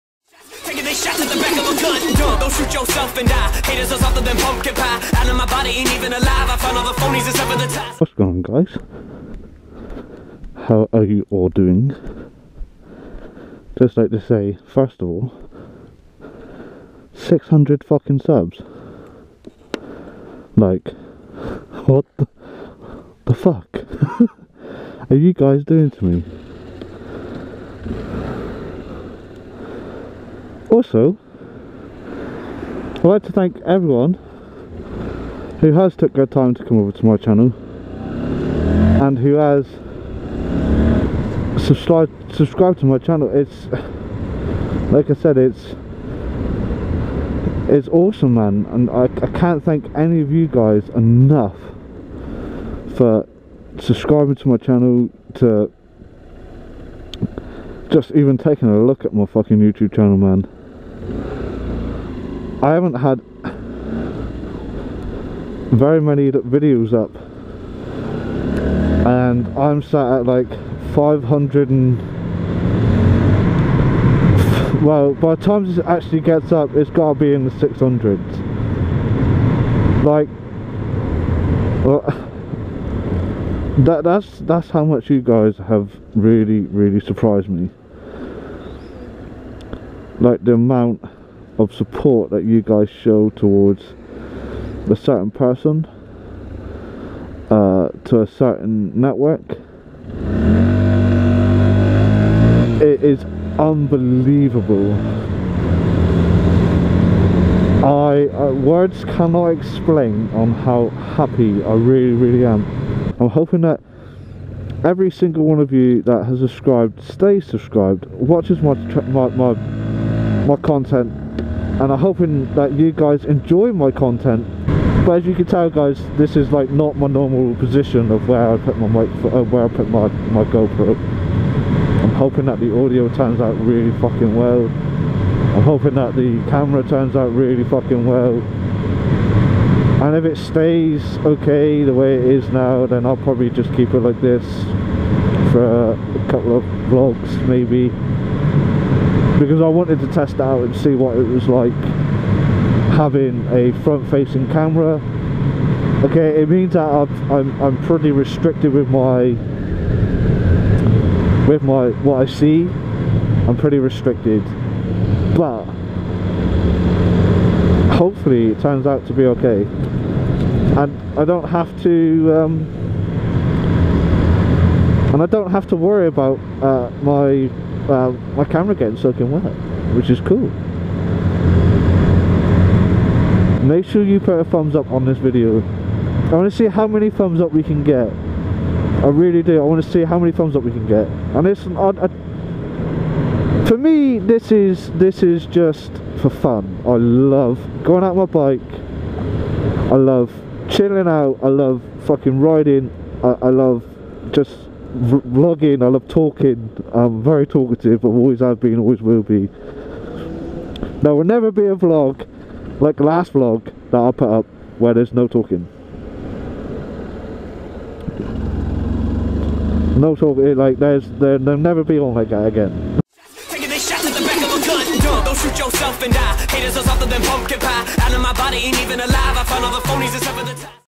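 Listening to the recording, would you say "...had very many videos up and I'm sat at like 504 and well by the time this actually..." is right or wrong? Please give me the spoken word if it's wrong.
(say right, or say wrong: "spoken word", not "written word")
wrong: "500", not "504".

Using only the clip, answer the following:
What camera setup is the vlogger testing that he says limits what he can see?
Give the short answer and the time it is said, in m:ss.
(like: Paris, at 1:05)
front facing camera, at 2:33.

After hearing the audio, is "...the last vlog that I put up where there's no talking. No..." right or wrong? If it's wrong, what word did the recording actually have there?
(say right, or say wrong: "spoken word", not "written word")
right.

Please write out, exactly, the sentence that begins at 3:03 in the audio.
Make sure you put a thumbs up on this video.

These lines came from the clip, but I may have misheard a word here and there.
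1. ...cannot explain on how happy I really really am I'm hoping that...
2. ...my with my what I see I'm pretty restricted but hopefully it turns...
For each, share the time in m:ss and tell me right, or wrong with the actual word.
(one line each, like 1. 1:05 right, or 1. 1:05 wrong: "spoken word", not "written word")
1. 1:49 right
2. 2:38 right.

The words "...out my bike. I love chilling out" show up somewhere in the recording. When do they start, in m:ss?
3:18.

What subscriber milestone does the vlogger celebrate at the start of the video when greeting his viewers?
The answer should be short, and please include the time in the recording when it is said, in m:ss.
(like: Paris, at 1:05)
600, at 0:17.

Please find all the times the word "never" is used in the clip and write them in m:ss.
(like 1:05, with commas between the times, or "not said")
3:31, 3:41.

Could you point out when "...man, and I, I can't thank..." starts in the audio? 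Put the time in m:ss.
0:48.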